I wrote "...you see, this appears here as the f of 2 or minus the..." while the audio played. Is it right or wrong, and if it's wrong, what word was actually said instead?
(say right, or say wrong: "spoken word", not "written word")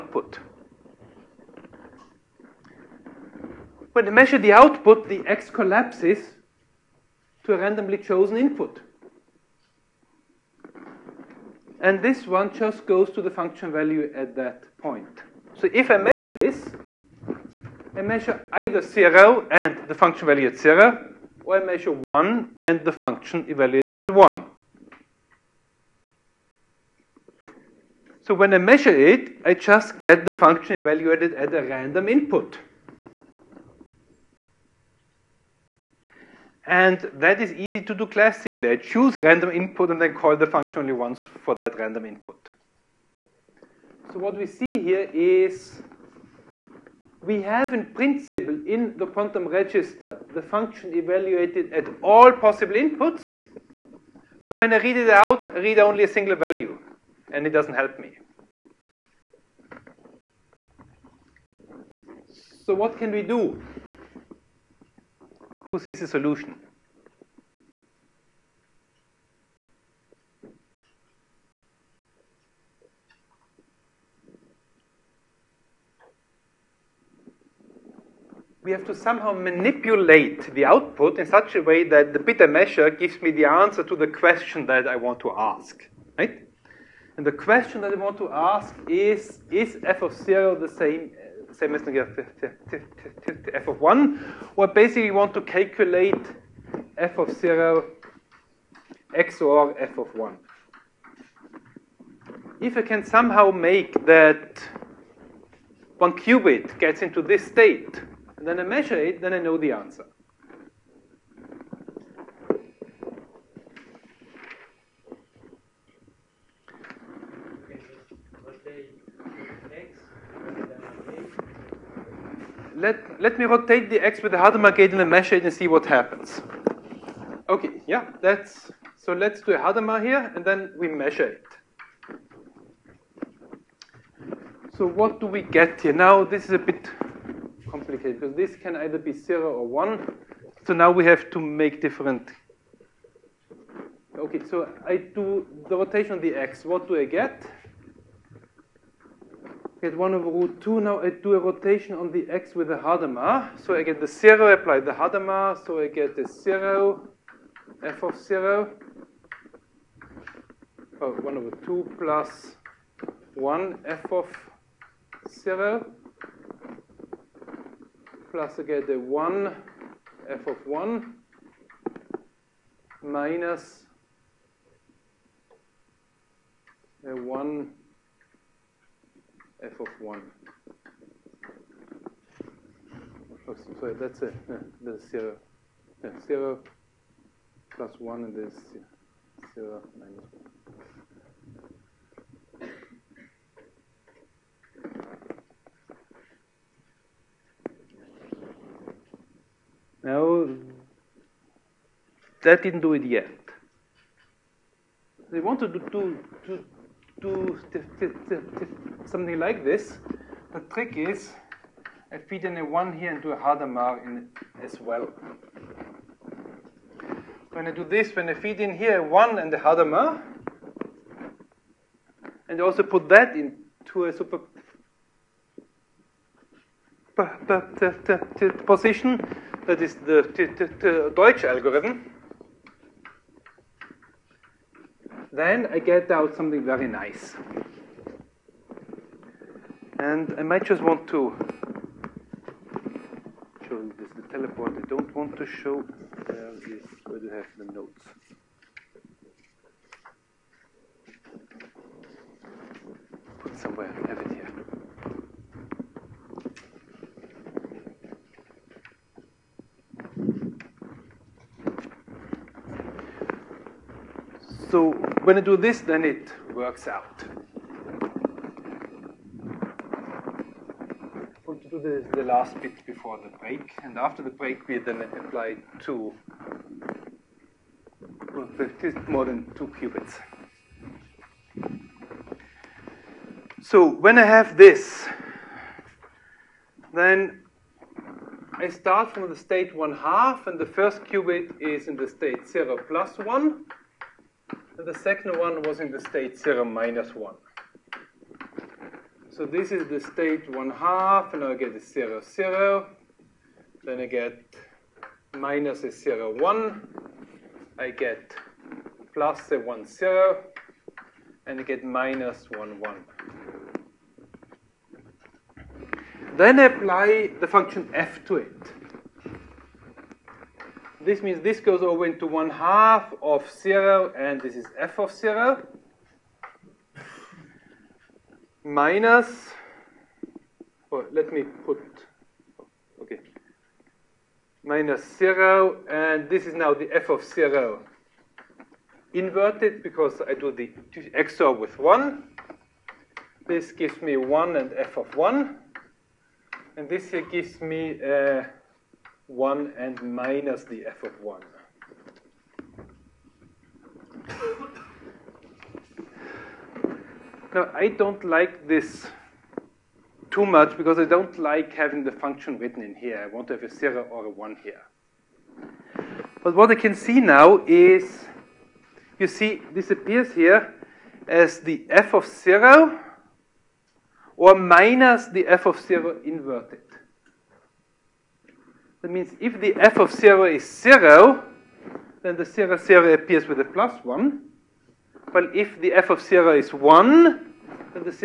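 wrong: "0", not "2".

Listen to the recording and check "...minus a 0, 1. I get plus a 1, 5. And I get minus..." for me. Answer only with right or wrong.
wrong.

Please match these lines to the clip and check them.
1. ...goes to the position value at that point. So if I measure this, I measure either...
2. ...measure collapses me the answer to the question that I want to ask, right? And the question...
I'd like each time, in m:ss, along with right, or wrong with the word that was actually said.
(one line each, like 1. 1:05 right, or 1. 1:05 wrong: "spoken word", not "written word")
1. 0:12 wrong: "function", not "position"
2. 1:22 wrong: "gives", not "collapses".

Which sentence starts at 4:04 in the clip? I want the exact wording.
I don't want to show, uh, there is, where do I have the notes?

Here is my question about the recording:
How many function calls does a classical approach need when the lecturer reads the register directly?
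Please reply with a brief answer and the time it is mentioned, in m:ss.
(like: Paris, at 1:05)
Once, at 0:40.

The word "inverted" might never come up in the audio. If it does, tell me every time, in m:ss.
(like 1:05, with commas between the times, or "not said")
5:39, 6:16.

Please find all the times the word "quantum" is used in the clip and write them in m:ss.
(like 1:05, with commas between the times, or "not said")
0:49.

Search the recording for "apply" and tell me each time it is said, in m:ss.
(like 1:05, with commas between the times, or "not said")
2:34, 4:35, 5:16.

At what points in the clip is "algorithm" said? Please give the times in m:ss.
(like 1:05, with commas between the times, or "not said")
3:51.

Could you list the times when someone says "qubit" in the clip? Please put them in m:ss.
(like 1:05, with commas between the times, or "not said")
1:46, 4:39, 4:51.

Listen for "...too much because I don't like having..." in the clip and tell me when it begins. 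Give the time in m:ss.
6:00.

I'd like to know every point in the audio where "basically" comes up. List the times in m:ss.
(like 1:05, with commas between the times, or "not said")
1:34.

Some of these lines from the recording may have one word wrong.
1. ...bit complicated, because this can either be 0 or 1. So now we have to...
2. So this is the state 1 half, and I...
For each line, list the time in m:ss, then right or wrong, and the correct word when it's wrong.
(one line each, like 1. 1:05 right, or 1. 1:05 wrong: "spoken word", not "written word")
1. 2:16 right
2. 4:59 right.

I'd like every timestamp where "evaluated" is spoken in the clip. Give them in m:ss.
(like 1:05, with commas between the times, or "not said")
0:23, 0:30, 0:50.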